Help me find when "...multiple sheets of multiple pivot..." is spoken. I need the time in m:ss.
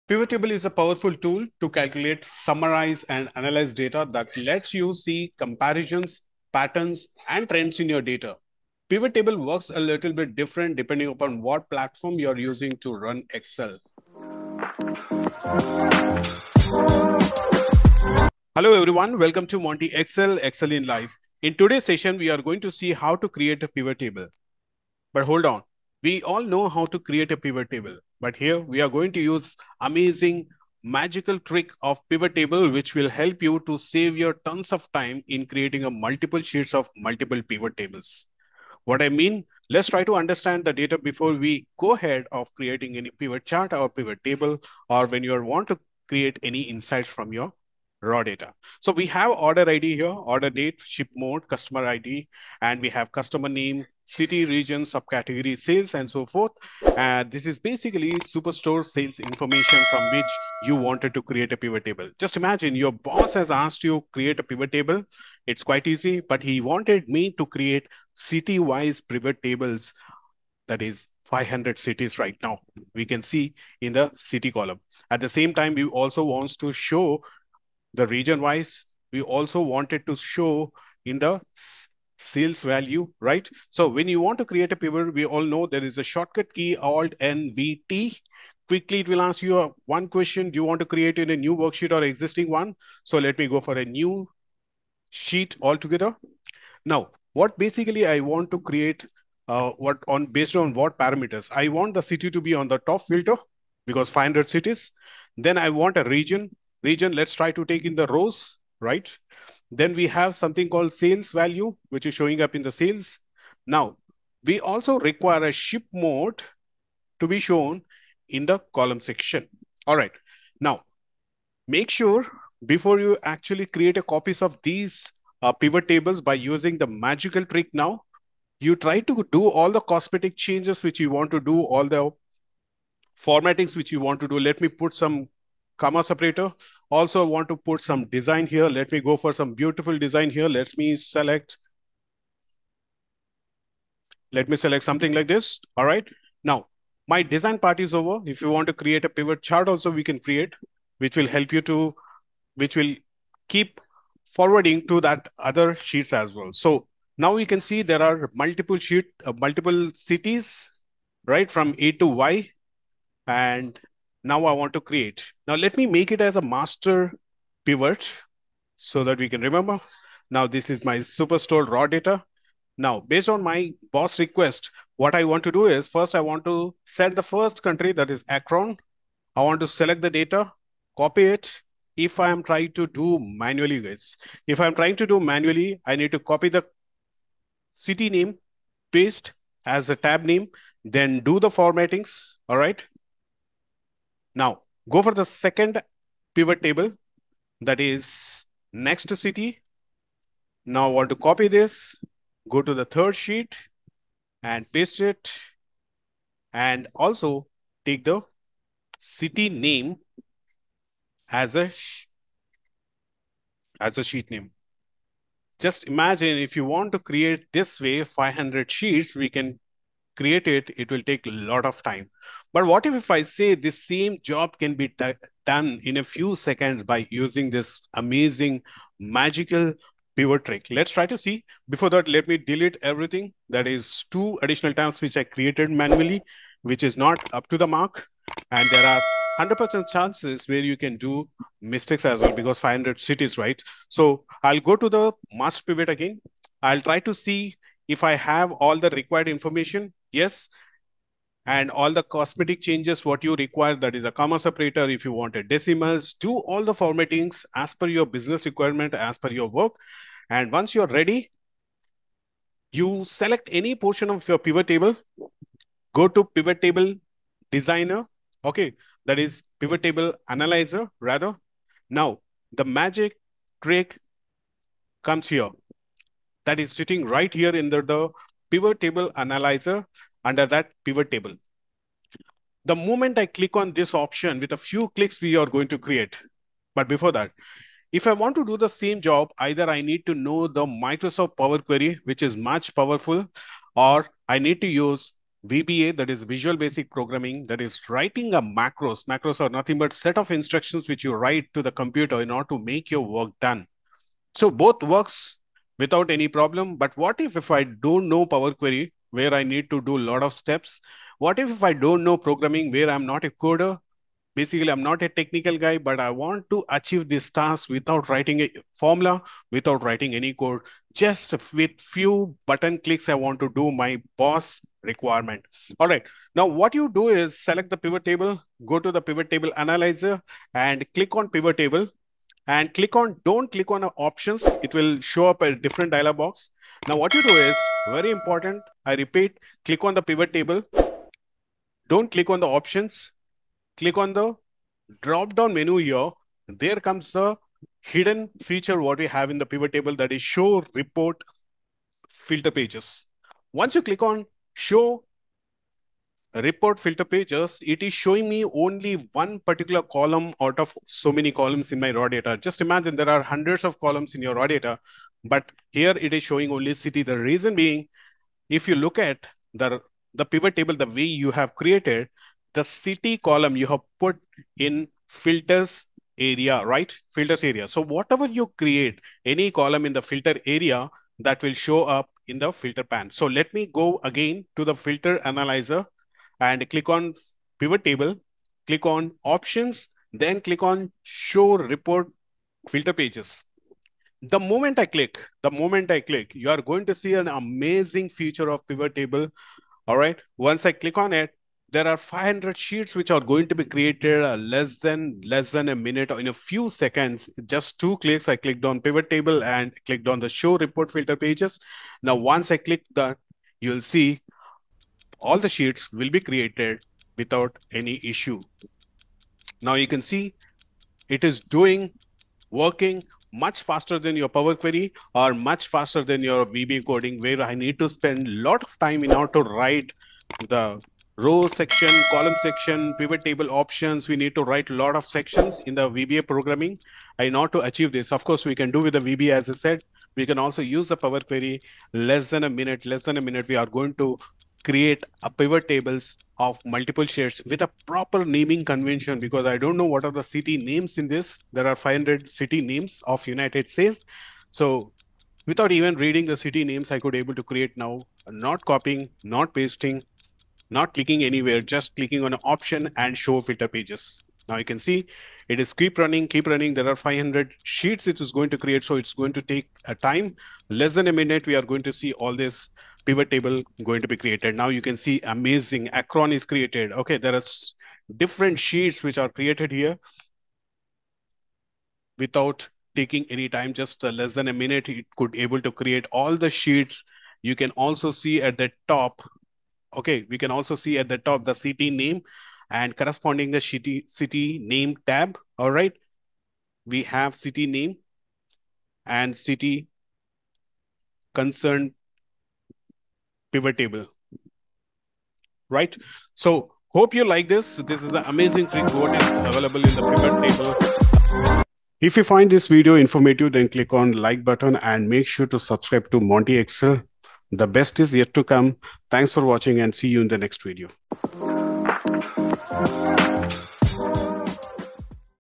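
0:35.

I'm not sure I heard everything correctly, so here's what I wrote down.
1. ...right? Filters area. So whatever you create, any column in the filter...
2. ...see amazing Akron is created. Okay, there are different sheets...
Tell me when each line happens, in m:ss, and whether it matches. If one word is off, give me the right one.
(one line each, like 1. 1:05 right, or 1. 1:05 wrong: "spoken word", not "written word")
1. 6:16 right
2. 7:54 right.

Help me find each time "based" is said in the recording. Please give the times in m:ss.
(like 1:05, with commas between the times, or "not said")
1:40, 2:53.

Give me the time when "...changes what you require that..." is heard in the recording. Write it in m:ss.
4:12.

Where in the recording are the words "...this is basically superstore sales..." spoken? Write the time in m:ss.
0:57.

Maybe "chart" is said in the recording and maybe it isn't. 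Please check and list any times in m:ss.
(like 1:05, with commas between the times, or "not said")
0:43, 2:29.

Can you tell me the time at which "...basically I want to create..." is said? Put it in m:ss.
1:37.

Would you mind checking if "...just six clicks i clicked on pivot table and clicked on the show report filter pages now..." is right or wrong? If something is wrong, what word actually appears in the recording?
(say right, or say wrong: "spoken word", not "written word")
wrong: "two", not "six".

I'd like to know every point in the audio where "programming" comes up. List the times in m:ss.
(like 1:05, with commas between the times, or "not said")
4:56, 5:12, 7:16.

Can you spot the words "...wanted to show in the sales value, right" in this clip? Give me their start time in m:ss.
1:19.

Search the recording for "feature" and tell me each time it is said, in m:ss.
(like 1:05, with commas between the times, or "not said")
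5:48, 6:38.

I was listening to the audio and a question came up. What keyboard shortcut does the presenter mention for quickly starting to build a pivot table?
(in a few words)
Alt N B T.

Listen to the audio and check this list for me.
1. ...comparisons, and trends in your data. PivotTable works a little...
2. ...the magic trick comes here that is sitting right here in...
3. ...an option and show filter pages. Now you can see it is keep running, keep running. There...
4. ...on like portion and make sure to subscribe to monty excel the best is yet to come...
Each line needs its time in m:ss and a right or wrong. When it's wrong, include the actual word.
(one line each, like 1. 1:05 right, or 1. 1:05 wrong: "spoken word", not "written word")
1. 0:06 wrong: "patterns", not "comparisons"
2. 4:32 right
3. 7:42 right
4. 8:33 wrong: "button", not "portion".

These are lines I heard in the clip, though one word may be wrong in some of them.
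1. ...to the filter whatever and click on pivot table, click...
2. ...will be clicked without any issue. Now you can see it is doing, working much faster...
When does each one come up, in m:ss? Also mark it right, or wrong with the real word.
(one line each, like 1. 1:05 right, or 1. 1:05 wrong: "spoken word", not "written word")
1. 6:24 wrong: "analyzer", not "whatever"
2. 6:55 wrong: "created", not "clicked".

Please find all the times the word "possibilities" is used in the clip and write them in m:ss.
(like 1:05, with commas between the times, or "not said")
not said.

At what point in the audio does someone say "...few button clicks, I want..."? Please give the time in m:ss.
5:21.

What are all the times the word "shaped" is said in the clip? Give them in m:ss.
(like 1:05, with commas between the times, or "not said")
not said.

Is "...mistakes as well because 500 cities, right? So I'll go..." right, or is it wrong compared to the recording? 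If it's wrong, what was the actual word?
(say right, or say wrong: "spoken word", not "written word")
right.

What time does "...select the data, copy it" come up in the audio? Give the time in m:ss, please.
2:59.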